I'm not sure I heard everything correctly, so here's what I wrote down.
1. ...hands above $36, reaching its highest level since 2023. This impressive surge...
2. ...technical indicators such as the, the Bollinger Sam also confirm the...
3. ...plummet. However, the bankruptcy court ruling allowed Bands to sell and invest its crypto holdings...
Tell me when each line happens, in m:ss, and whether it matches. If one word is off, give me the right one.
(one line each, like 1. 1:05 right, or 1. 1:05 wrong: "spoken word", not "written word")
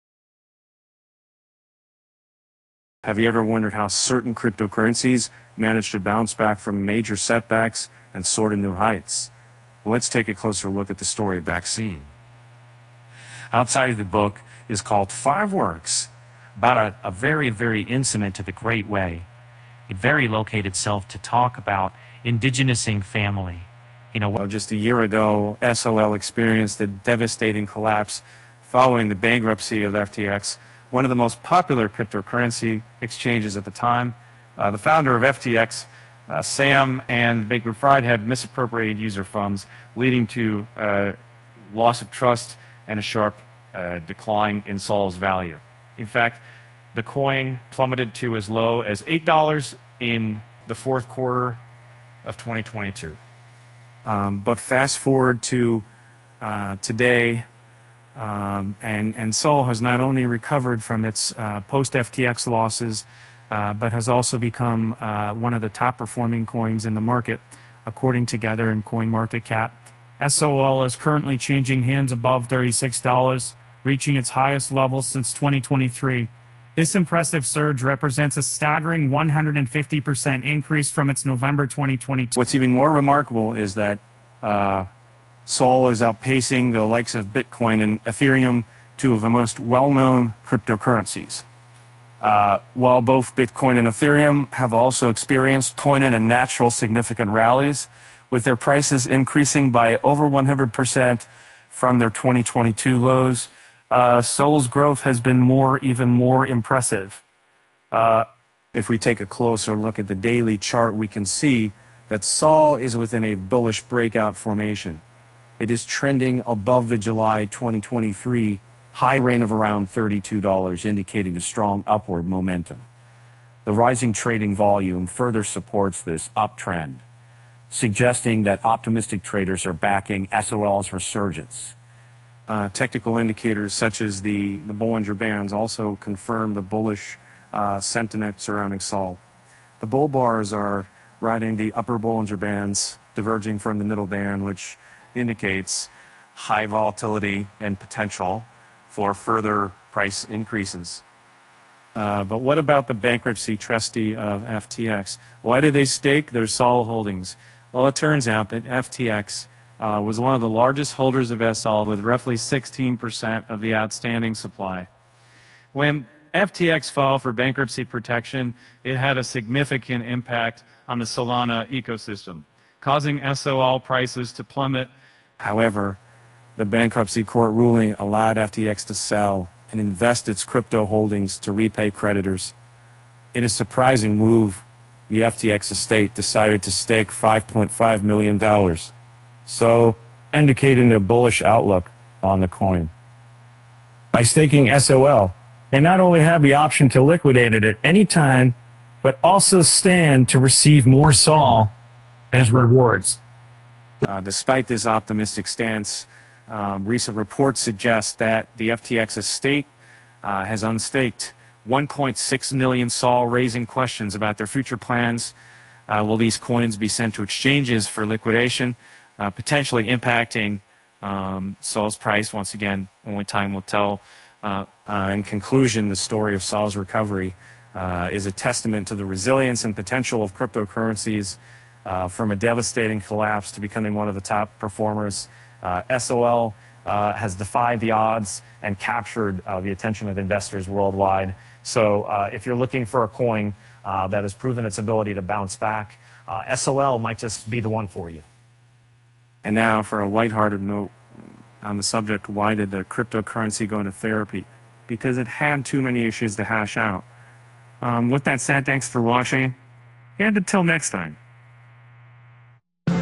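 1. 1:11 right
2. 2:12 wrong: "Bands", not "Sam"
3. 2:54 wrong: "FTX", not "Bands".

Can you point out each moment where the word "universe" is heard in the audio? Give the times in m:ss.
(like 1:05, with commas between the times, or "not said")
not said.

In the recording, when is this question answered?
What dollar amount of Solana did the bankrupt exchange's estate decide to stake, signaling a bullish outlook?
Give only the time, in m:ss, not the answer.
3:07.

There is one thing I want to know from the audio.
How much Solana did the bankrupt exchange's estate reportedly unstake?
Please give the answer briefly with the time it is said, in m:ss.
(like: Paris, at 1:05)
1.6 million SOL, at 3:31.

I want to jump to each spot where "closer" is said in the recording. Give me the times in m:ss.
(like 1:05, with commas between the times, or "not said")
0:10, 1:49.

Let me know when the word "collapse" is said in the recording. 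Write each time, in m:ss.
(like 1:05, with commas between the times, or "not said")
0:27, 3:53.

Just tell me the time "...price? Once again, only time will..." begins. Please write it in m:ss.
3:41.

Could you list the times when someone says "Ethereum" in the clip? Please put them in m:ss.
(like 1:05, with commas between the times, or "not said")
1:28, 1:33.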